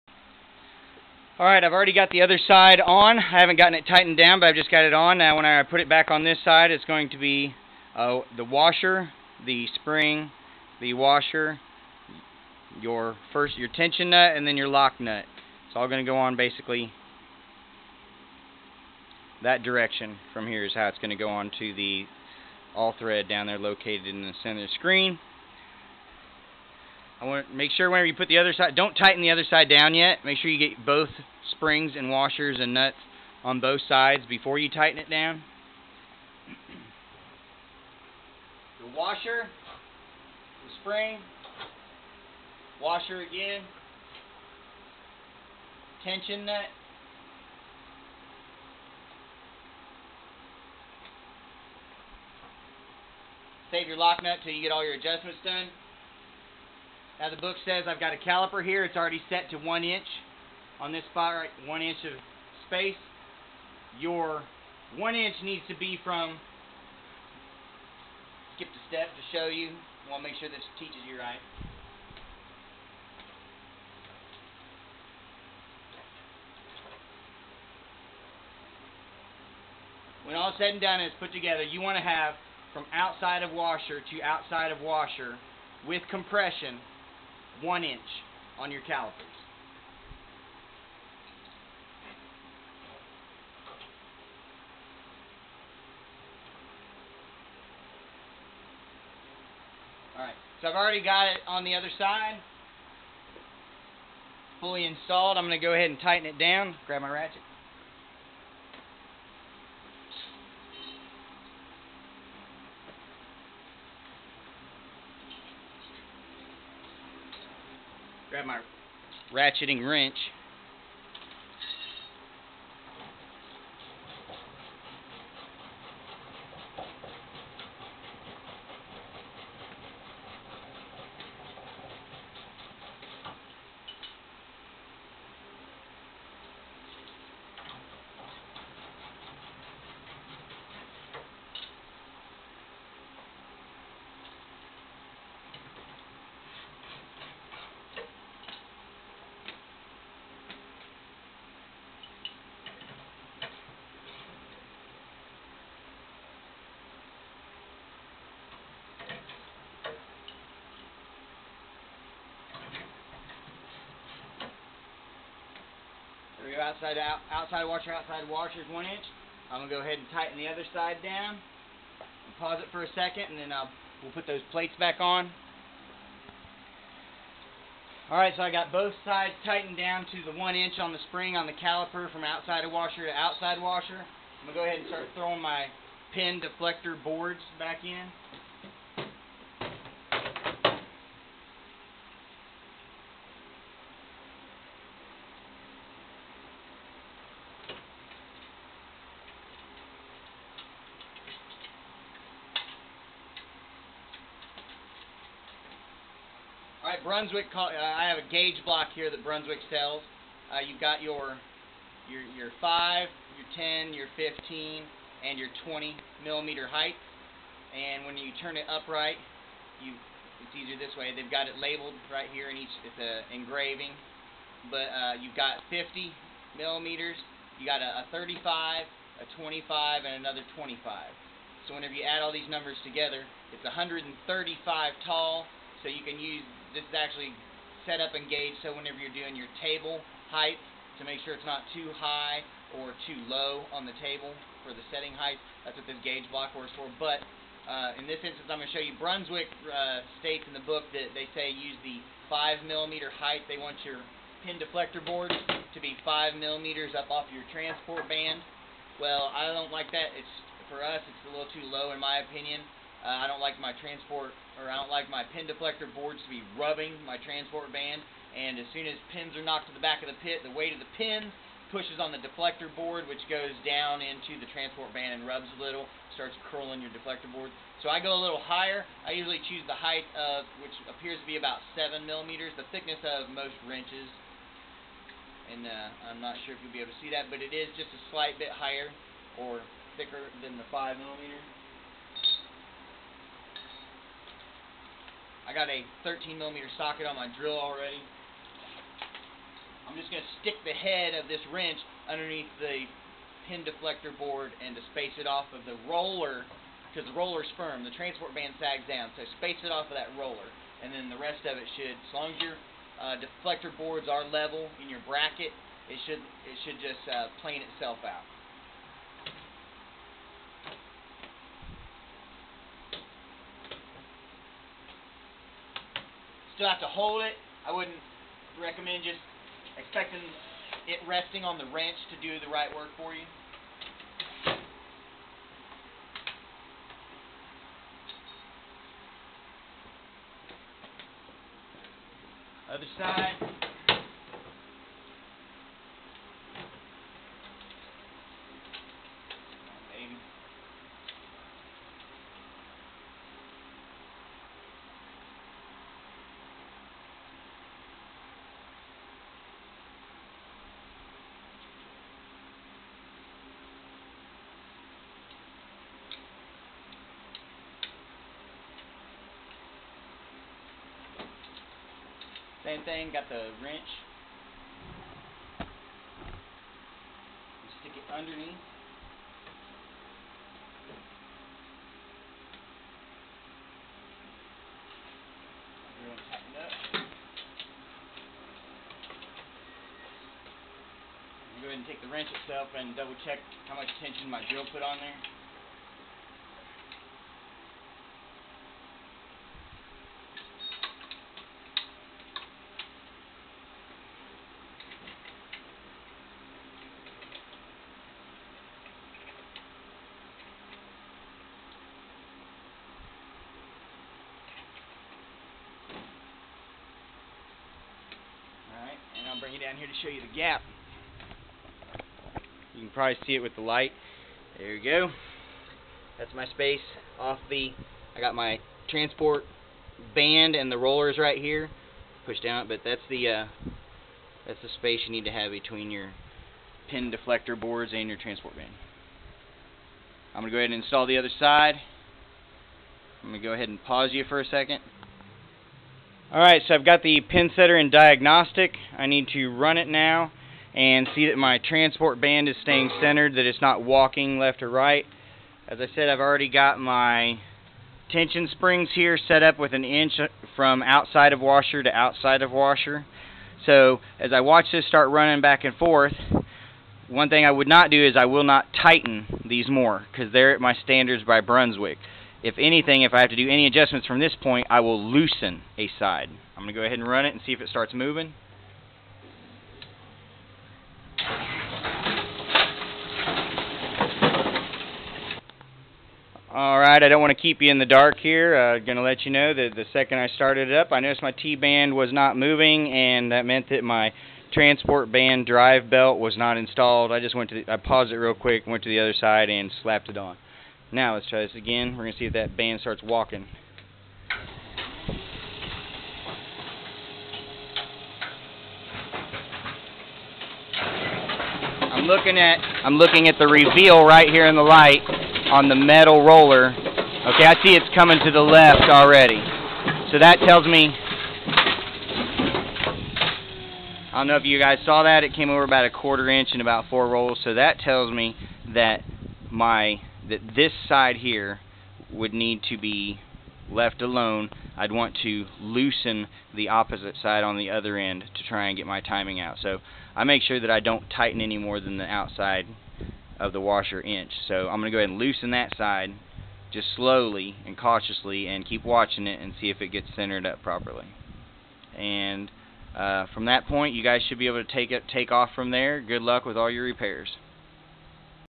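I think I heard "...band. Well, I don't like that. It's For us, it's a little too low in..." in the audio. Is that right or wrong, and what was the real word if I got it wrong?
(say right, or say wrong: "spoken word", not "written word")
right.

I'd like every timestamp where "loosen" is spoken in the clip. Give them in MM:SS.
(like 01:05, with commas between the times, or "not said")
07:55, 08:55, 09:05.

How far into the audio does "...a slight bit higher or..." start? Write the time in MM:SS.
04:47.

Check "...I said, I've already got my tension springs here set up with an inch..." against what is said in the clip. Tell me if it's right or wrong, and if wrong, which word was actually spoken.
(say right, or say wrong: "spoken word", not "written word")
right.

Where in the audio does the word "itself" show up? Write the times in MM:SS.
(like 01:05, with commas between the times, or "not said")
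05:17, 06:32.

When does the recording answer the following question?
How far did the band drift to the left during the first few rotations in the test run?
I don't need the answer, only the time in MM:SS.
08:45.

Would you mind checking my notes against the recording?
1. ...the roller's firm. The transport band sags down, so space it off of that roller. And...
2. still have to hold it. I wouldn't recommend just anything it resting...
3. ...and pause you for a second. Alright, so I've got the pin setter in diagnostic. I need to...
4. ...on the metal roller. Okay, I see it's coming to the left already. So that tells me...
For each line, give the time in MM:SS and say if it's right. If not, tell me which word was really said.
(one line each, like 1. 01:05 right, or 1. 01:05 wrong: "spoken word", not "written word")
1. 05:07 right
2. 05:26 wrong: "expecting", not "anything"
3. 07:23 right
4. 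08:35 right.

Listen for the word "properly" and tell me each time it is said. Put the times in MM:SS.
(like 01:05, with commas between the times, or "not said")
09:10.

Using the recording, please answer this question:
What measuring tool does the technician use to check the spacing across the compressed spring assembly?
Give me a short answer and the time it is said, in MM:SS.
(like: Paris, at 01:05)
calipers, at 01:28.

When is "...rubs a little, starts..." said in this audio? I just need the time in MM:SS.
04:35.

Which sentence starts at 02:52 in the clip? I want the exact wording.
Pause it for a second, and then I'll, uh, we'll put those plates back on.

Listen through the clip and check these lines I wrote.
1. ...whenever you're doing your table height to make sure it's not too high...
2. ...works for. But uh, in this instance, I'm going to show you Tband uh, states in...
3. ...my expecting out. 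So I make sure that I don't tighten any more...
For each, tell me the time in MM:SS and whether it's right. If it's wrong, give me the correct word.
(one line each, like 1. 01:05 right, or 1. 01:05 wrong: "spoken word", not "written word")
1. 03:58 right
2. 04:06 wrong: "Brunswick", not "Tband"
3. 08:58 wrong: "timing", not "expecting".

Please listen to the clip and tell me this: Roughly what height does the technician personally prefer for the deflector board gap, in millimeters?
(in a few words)
7.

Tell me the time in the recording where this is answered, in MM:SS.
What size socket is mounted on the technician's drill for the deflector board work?
04:56.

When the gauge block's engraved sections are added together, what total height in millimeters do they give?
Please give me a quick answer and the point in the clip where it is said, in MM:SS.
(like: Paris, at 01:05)
135, at 03:53.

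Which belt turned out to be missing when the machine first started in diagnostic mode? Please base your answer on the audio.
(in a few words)
transport band drive belt.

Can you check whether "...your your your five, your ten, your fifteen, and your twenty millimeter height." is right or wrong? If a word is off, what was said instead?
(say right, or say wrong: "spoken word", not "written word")
right.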